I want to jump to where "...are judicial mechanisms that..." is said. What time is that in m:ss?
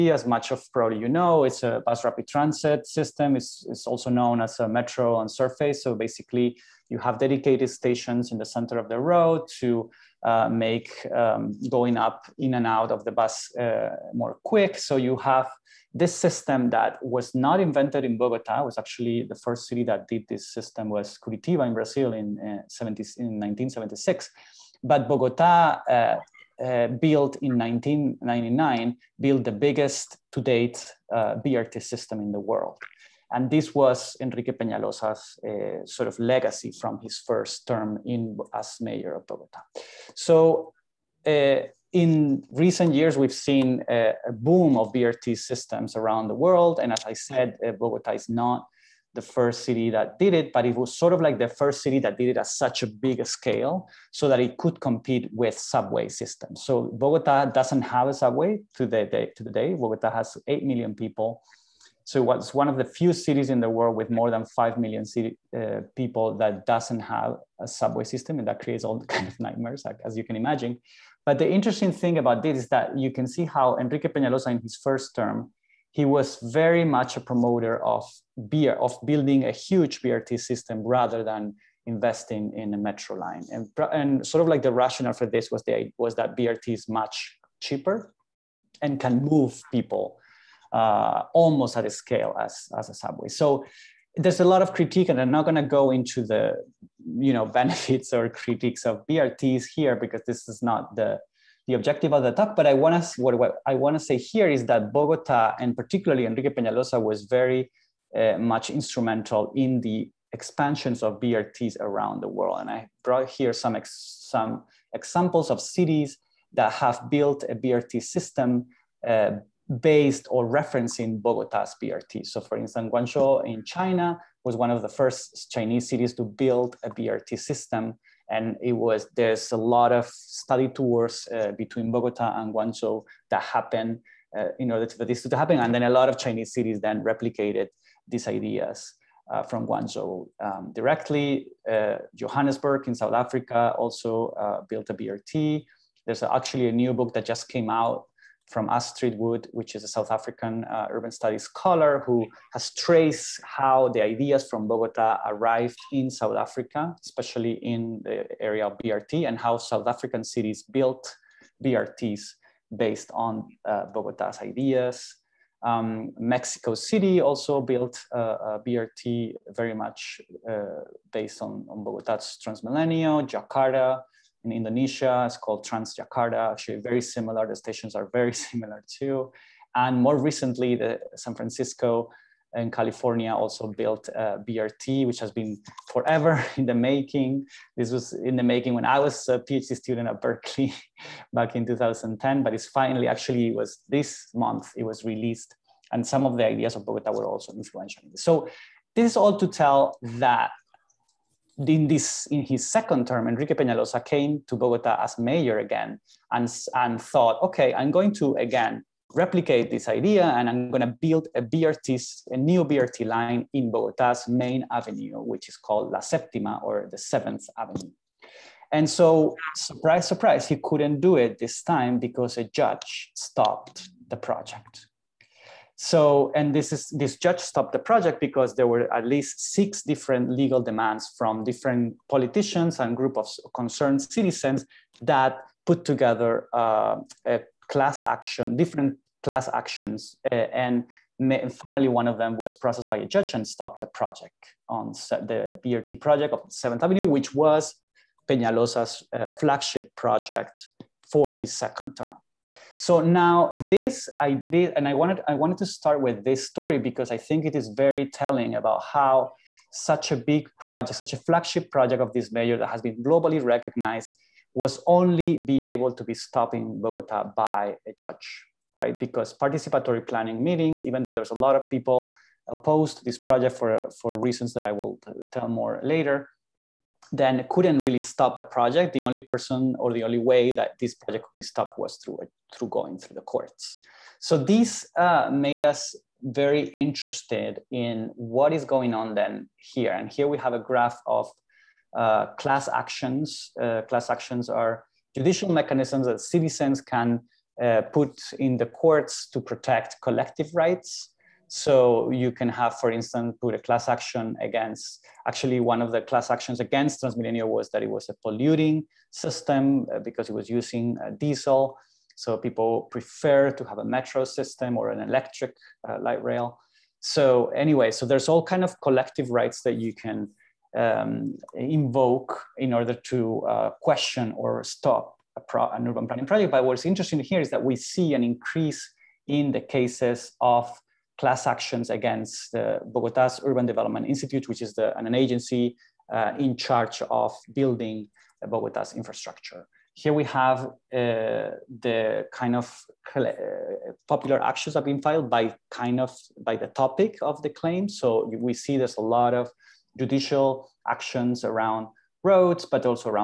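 4:54.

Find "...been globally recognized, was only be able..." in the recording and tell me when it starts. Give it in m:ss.
4:22.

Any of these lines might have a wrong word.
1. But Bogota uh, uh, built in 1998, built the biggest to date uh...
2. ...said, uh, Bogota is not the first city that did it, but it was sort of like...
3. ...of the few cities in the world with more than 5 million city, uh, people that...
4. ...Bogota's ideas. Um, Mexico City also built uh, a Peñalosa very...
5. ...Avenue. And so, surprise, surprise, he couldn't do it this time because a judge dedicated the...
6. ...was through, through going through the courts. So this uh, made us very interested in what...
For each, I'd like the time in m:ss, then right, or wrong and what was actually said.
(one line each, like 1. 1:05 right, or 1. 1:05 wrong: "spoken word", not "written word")
1. 0:24 wrong: "1999", not "1998"
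2. 0:47 right
3. 1:02 right
4. 2:43 wrong: "BRT", not "Peñalosa"
5. 3:37 wrong: "stopped", not "dedicated"
6. 4:41 right.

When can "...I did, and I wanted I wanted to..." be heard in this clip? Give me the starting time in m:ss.
4:14.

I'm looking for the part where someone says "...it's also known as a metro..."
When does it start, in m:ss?
0:03.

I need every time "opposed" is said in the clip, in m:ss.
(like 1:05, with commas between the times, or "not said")
4:32.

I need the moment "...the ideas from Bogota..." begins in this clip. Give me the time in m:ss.
2:33.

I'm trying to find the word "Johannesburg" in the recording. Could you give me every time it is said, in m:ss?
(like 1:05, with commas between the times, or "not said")
2:22.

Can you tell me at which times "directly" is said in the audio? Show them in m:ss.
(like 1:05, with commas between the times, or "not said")
2:20.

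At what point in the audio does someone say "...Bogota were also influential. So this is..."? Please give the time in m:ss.
3:16.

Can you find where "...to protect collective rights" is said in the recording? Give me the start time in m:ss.
4:59.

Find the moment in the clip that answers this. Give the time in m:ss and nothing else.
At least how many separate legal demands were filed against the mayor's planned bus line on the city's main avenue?
3:49.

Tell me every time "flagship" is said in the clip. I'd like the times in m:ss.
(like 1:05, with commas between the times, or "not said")
4:09, 4:21.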